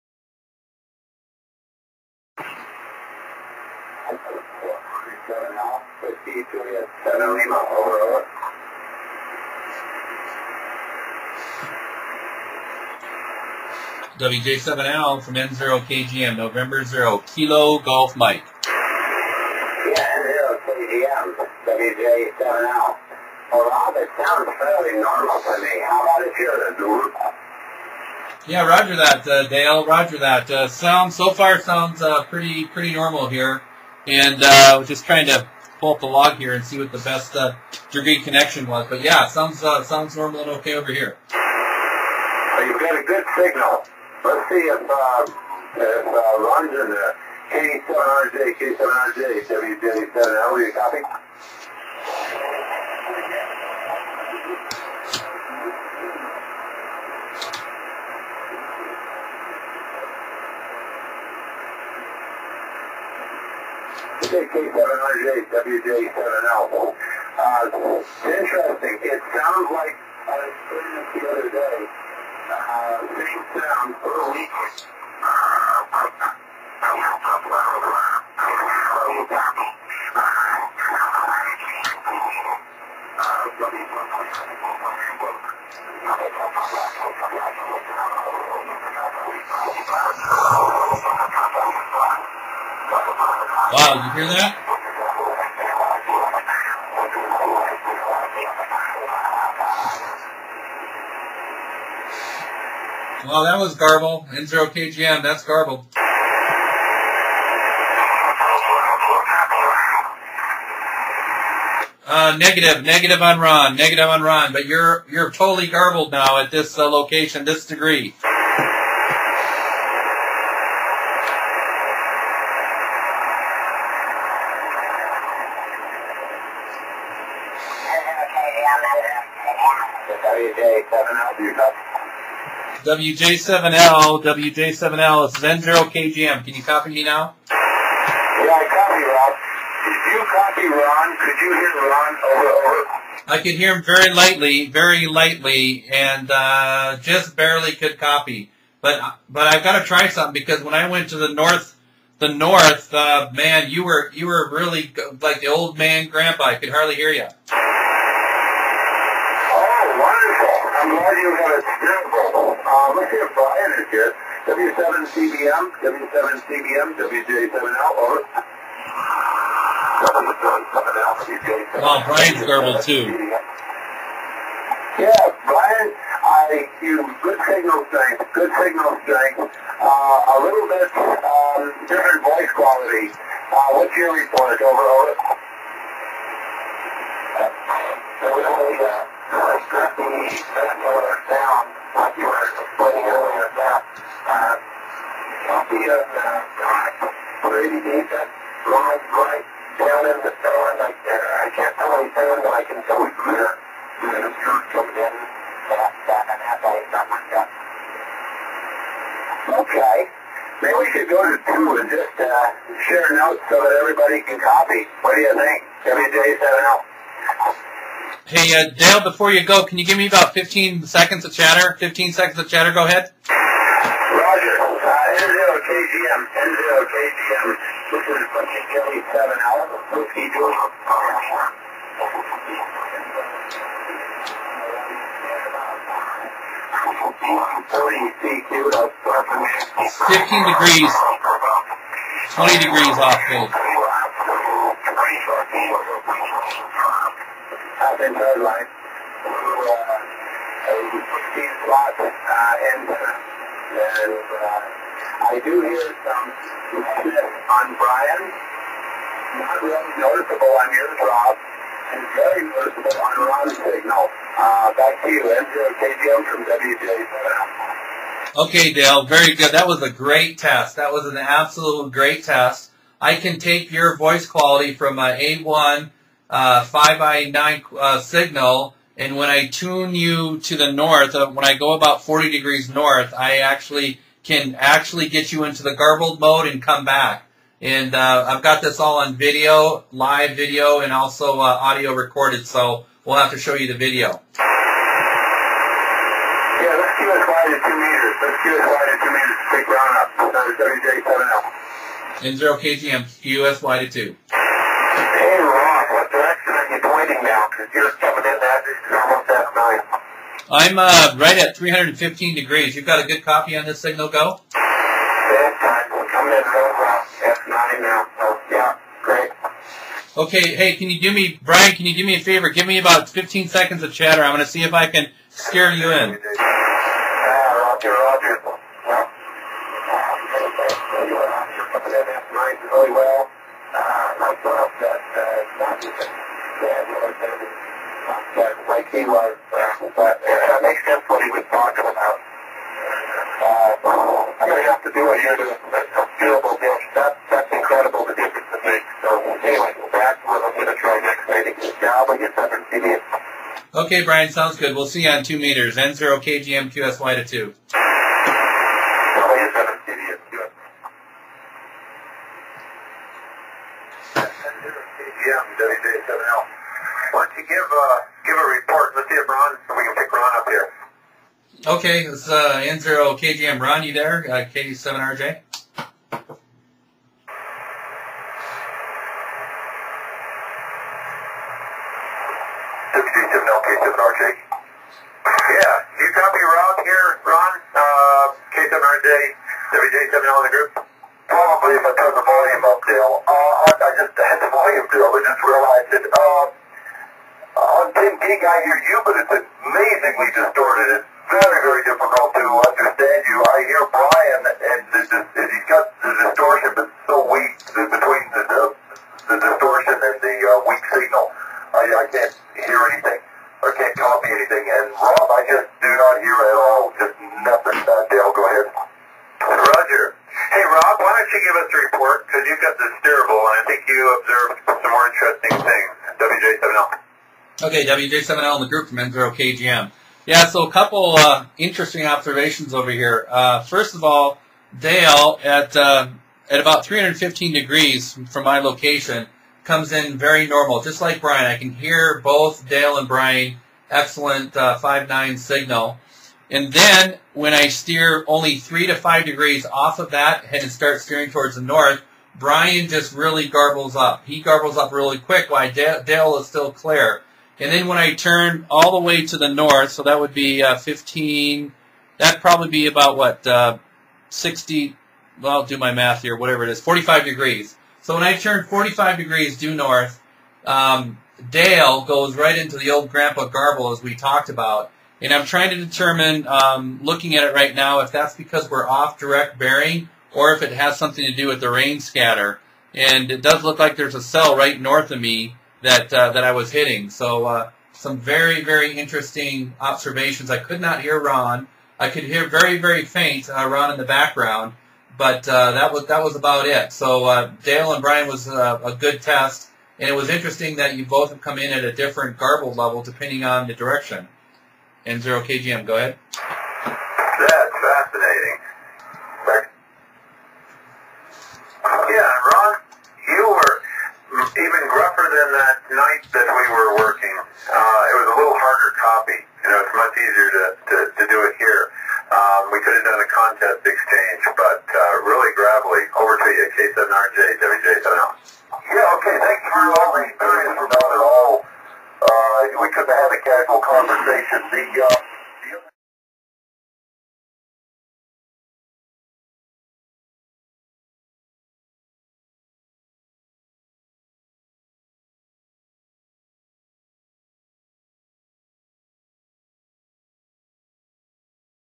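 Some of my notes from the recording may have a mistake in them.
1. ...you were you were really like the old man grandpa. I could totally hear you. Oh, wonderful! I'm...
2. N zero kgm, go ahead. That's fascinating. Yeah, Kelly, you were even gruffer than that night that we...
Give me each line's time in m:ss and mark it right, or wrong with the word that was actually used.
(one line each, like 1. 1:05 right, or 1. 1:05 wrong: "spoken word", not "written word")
1. 2:33 wrong: "hardly", not "totally"
2. 8:25 wrong: "Ron", not "Kelly".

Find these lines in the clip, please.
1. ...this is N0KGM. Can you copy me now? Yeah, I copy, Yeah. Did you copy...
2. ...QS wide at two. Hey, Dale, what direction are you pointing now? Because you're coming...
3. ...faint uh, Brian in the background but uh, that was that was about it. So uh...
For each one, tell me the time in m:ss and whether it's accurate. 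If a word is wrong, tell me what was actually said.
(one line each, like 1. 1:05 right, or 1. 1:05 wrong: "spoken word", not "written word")
1. 2:15 wrong: "Rob", not "Yeah"
2. 5:03 wrong: "Rob", not "Dale"
3. 8:13 wrong: "Ron", not "Brian".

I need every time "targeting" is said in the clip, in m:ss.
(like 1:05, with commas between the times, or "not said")
not said.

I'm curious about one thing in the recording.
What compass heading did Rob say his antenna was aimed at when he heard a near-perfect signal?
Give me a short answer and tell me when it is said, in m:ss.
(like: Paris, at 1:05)
315 degrees, at 5:11.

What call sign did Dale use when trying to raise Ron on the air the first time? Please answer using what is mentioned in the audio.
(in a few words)
K7RJ.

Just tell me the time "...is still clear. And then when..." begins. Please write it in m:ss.
7:36.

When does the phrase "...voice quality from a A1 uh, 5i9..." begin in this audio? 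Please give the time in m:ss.
4:33.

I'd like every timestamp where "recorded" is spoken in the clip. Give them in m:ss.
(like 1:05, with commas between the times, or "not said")
4:51.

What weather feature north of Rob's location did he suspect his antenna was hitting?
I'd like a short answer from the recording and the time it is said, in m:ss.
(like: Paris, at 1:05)
a cell, at 8:04.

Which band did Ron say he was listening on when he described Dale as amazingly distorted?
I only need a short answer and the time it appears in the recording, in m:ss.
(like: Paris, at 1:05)
10 gig, at 6:37.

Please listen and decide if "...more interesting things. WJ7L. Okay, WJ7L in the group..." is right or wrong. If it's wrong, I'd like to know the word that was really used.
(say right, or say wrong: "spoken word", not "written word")
right.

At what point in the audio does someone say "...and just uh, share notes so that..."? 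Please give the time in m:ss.
3:31.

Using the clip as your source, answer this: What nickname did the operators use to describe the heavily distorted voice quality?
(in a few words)
Grandpa Garble.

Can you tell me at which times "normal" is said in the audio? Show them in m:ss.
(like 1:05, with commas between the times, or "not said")
0:25, 0:32, 0:40, 7:20.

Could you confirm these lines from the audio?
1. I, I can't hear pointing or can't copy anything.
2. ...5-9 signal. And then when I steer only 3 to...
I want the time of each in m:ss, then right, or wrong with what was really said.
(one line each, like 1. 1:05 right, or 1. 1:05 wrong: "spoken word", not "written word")
1. 6:51 wrong: "anything", not "pointing"
2. 7:24 right.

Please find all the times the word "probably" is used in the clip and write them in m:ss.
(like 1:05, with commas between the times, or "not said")
6:31, 7:42.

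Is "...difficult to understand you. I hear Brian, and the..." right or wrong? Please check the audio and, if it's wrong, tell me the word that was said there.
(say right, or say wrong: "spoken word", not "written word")
right.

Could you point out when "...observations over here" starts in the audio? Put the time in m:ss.
7:12.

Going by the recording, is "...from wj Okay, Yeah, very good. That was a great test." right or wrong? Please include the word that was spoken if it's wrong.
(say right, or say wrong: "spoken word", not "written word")
wrong: "Dale", not "Yeah".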